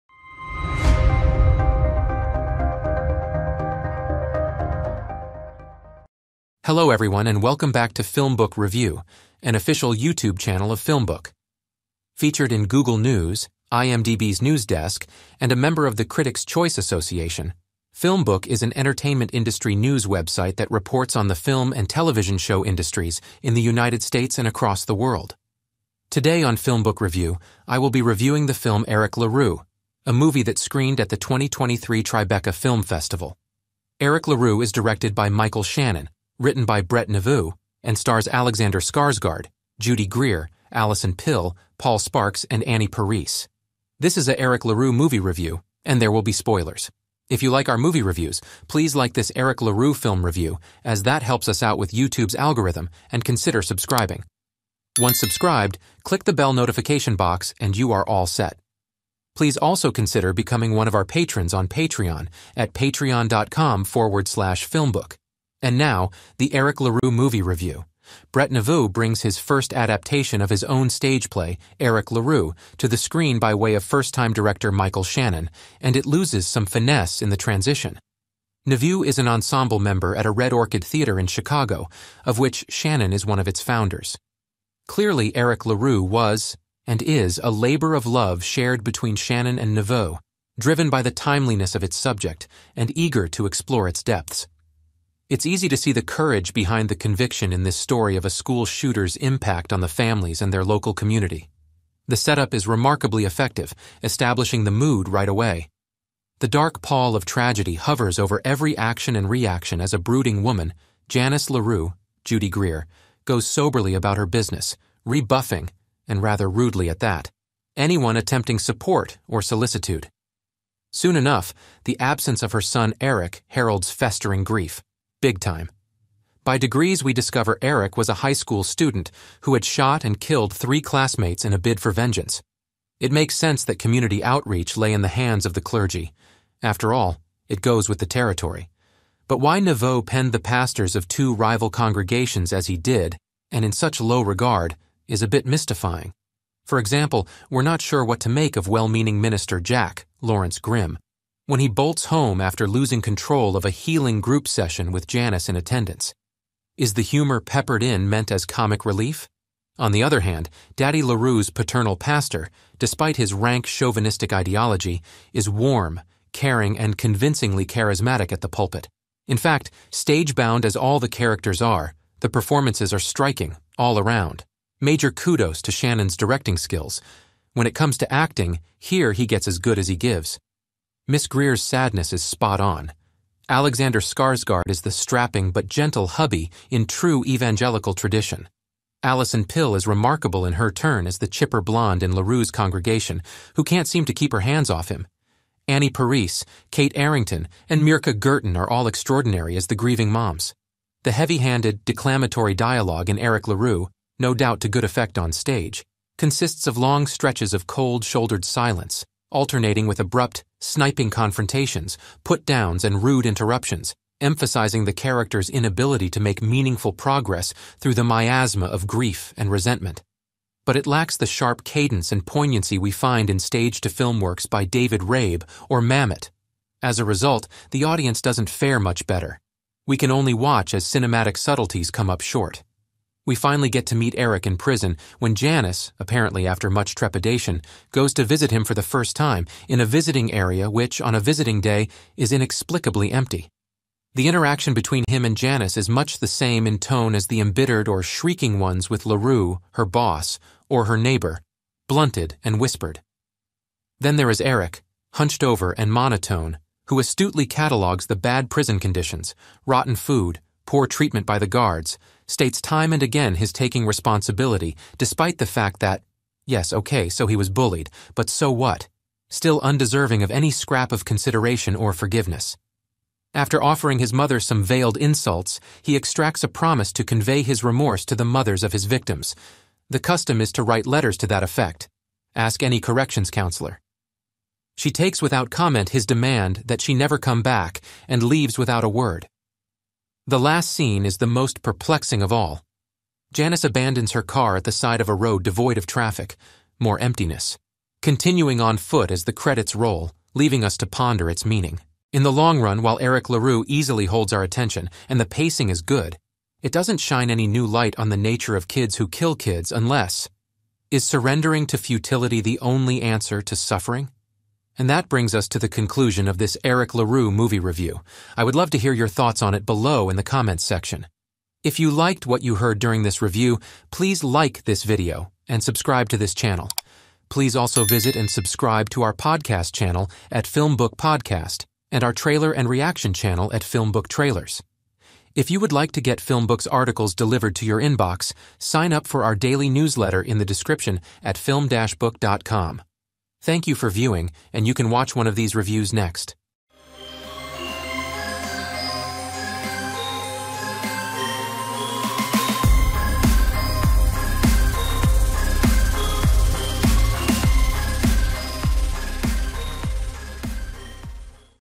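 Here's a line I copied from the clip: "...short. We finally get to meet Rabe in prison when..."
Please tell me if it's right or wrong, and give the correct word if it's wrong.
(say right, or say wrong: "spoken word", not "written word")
wrong: "Eric", not "Rabe".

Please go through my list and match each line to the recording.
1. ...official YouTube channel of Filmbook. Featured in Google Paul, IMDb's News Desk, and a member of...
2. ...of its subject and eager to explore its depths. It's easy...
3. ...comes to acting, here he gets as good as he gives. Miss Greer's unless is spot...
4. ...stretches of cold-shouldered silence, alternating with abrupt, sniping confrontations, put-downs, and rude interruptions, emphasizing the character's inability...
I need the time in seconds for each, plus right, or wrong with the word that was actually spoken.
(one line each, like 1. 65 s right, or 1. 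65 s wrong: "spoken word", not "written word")
1. 9 s wrong: "News", not "Paul"
2. 91 s right
3. 177 s wrong: "sadness", not "unless"
4. 207 s right.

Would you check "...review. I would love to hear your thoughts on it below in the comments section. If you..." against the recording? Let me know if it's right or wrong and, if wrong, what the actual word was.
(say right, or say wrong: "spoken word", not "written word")
right.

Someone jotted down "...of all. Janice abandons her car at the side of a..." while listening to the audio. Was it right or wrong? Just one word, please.
right.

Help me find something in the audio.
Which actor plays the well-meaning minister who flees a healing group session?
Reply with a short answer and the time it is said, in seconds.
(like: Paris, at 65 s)
Lawrence Grimm, at 150 s.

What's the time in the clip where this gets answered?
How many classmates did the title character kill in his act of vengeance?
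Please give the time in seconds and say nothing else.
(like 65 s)
130 s.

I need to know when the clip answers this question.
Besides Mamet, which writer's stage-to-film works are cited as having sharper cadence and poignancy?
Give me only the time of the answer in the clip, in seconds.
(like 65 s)
224 s.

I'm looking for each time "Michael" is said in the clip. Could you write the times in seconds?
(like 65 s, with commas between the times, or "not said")
35 s, 74 s.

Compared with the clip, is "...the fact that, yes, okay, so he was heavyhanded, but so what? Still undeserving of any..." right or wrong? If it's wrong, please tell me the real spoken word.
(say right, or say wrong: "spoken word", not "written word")
wrong: "bullied", not "heavyhanded".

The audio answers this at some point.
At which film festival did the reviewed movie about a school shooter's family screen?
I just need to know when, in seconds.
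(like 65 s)
31 s.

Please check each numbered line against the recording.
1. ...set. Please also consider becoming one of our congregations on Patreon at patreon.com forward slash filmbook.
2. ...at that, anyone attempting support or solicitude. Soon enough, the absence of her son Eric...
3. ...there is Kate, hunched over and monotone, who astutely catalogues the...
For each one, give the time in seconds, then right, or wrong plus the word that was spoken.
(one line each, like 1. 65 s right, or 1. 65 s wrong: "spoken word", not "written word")
1. 58 s wrong: "patrons", not "congregations"
2. 116 s right
3. 254 s wrong: "Eric", not "Kate".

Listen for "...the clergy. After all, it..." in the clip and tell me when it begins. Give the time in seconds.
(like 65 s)
135 s.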